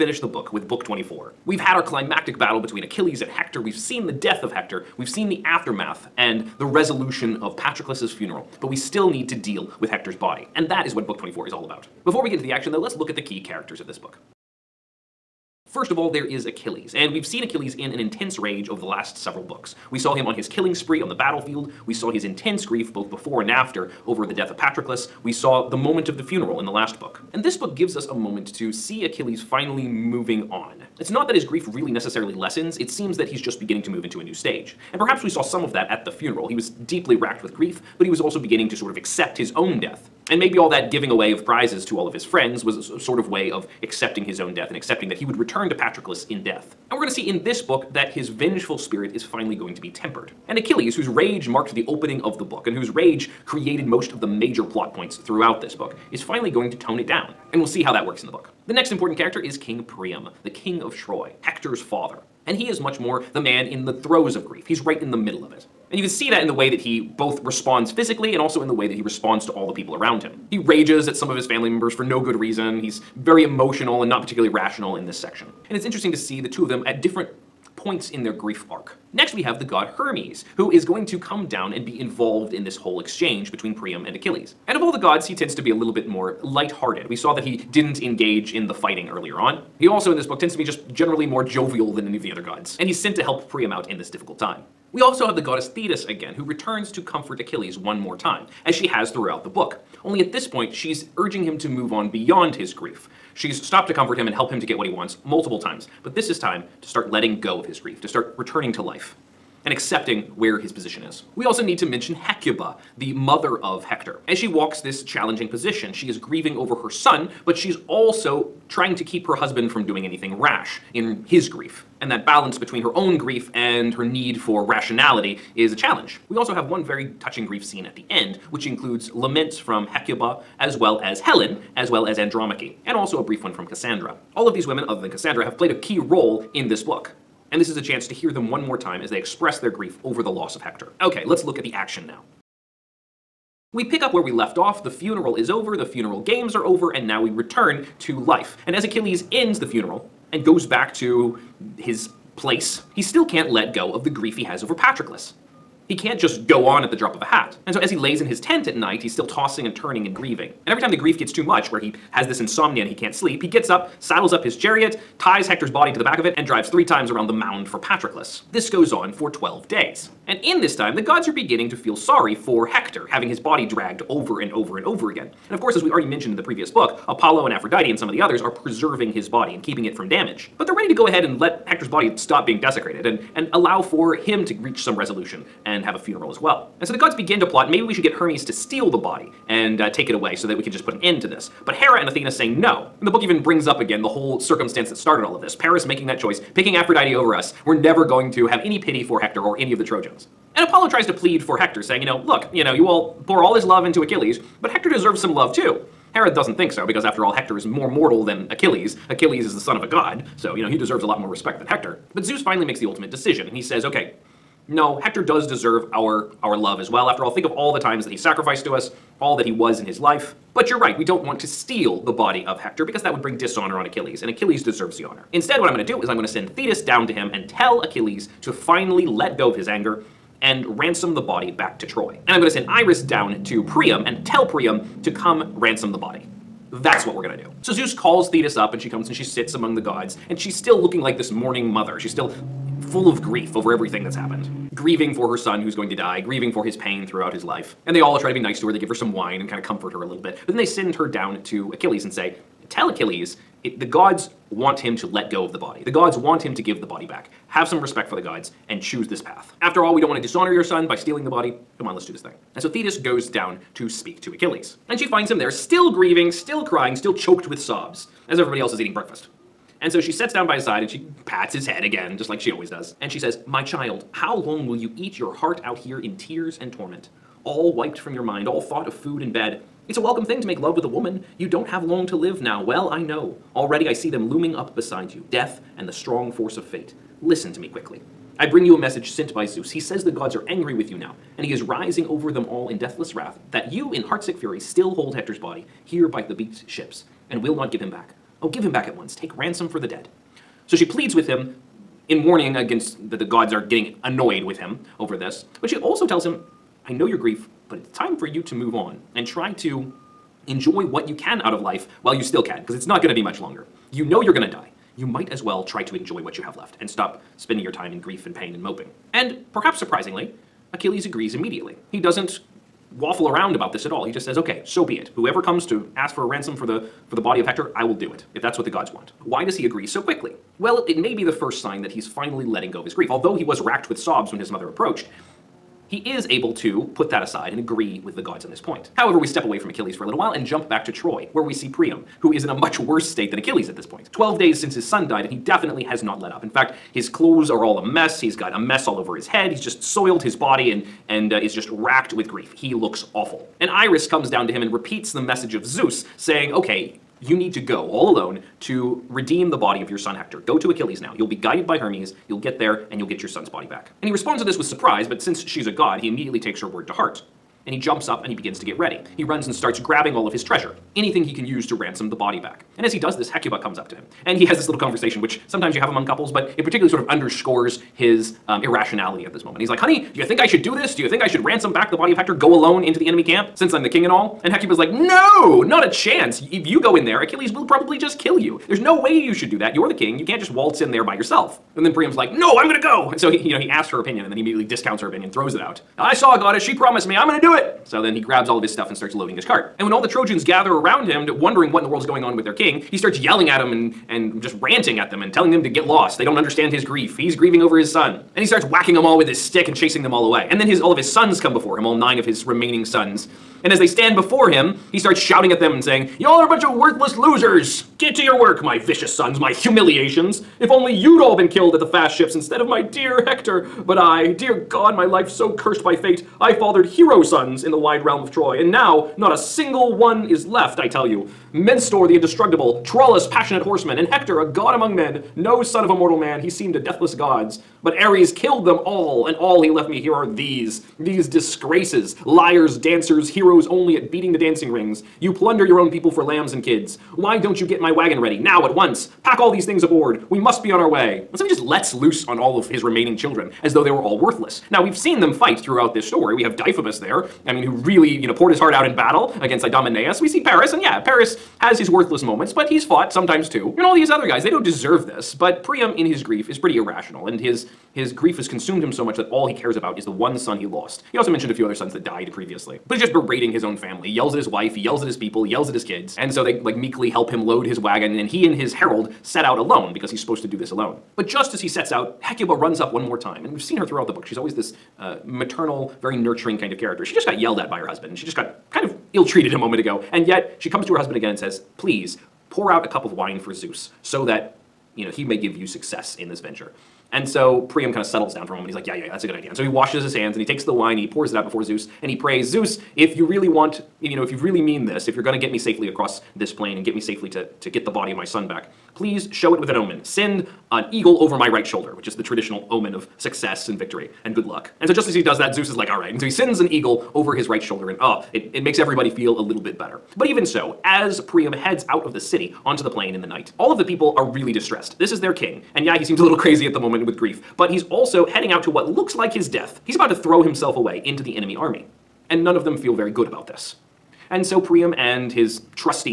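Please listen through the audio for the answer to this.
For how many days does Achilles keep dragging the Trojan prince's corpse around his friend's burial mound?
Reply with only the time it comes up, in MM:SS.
02:49.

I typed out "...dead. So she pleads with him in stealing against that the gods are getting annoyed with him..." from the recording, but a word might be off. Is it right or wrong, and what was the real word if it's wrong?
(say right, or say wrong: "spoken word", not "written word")
wrong: "warning", not "stealing".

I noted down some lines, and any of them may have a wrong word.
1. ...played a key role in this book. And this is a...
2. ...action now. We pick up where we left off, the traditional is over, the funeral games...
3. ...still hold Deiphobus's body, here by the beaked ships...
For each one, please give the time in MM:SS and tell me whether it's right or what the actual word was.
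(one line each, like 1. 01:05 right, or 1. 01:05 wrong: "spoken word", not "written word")
1. 02:15 right
2. 02:21 wrong: "funeral", not "traditional"
3. 04:54 wrong: "Hector", not "Deiphobus".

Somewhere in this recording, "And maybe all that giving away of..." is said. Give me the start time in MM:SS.
00:40.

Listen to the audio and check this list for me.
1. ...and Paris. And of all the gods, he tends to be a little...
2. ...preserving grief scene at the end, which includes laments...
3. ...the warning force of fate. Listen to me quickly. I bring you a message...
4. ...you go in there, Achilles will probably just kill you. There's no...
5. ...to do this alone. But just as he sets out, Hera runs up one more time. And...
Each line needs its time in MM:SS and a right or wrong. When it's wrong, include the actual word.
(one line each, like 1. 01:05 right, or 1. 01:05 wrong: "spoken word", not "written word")
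1. 01:24 wrong: "Achilles", not "Paris"
2. 02:07 wrong: "touching", not "preserving"
3. 04:45 wrong: "strong", not "warning"
4. 06:26 right
5. 08:00 wrong: "Hecuba", not "Hera".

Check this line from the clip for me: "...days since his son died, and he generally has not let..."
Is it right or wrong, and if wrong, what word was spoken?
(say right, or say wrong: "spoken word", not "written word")
wrong: "definitely", not "generally".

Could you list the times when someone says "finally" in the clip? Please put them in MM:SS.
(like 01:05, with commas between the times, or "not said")
00:29, 00:49, 00:56, 03:32, 03:48, 05:32.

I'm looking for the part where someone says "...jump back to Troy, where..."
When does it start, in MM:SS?
05:40.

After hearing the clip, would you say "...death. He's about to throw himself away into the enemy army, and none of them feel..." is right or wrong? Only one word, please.
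right.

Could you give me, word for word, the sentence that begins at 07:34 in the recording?
Now, we've seen them fight throughout this story.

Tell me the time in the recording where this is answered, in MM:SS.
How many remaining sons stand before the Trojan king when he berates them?
06:51.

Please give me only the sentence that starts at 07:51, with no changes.
He also mentioned a few other sons that died previously.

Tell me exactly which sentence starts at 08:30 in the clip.
Send an eagle over my right shoulder, which is the traditional omen of success and victory and good luck.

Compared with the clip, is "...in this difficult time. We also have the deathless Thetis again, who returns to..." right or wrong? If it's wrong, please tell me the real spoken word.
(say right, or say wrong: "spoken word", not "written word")
wrong: "goddess", not "deathless".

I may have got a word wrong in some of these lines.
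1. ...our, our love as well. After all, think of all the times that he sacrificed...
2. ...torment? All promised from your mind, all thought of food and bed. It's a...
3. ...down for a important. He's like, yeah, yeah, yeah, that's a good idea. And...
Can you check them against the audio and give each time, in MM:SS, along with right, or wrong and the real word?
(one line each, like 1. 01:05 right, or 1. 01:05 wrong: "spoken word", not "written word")
1. 03:35 right
2. 04:36 wrong: "wiped", not "promised"
3. 08:18 wrong: "moment", not "important".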